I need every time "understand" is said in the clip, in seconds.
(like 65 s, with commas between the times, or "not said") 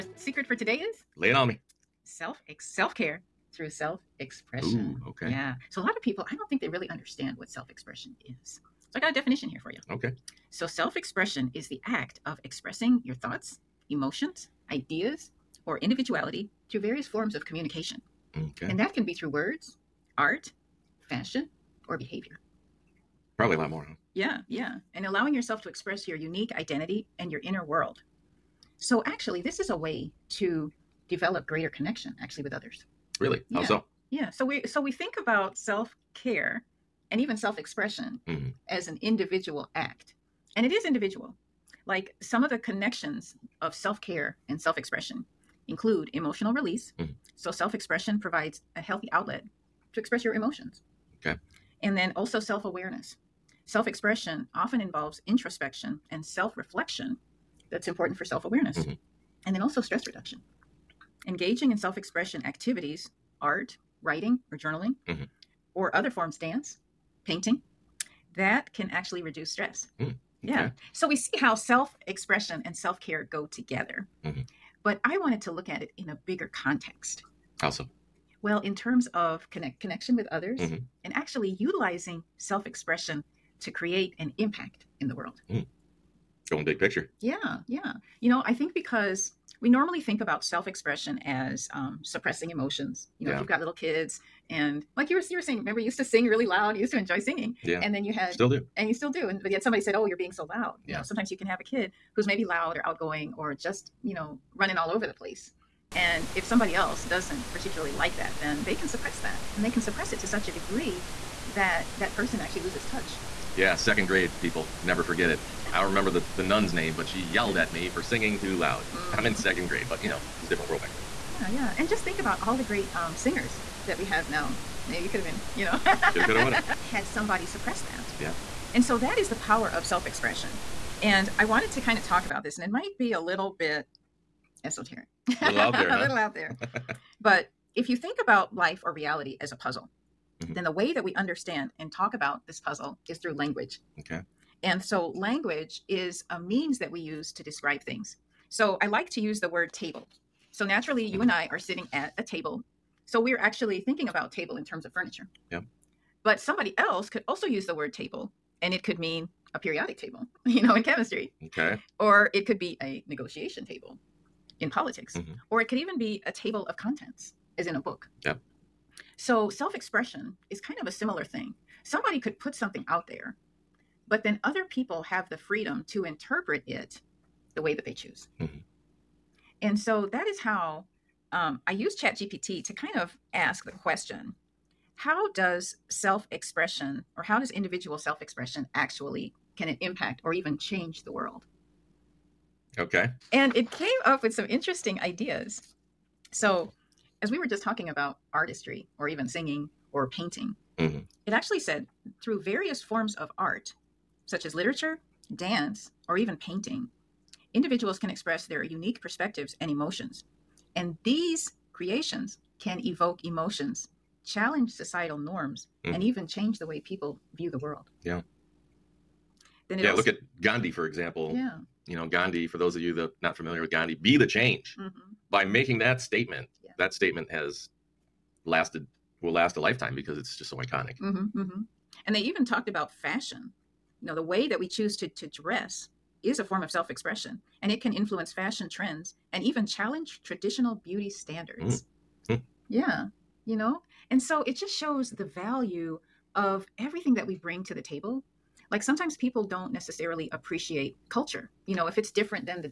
6 s, 141 s.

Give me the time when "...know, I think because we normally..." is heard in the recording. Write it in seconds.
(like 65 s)
88 s.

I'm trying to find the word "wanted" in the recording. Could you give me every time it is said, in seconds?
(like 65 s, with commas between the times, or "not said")
75 s, 131 s.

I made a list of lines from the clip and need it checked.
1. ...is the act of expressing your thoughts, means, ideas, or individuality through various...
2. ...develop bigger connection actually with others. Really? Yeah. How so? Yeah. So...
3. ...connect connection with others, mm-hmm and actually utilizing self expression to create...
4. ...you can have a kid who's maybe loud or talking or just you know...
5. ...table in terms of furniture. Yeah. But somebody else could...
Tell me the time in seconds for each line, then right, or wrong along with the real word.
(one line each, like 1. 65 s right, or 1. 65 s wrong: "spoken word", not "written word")
1. 11 s wrong: "emotions", not "means"
2. 31 s wrong: "greater", not "bigger"
3. 79 s right
4. 101 s wrong: "outgoing", not "talking"
5. 154 s right.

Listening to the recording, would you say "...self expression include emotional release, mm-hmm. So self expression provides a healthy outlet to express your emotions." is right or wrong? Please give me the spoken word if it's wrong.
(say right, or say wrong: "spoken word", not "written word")
right.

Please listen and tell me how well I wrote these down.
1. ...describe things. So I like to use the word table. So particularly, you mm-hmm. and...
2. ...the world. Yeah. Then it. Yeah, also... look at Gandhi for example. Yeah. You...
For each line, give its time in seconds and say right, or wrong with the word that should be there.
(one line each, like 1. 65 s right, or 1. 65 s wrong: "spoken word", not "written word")
1. 147 s wrong: "naturally", not "particularly"
2. 217 s right.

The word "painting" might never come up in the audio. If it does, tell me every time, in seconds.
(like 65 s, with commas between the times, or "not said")
67 s, 200 s, 206 s.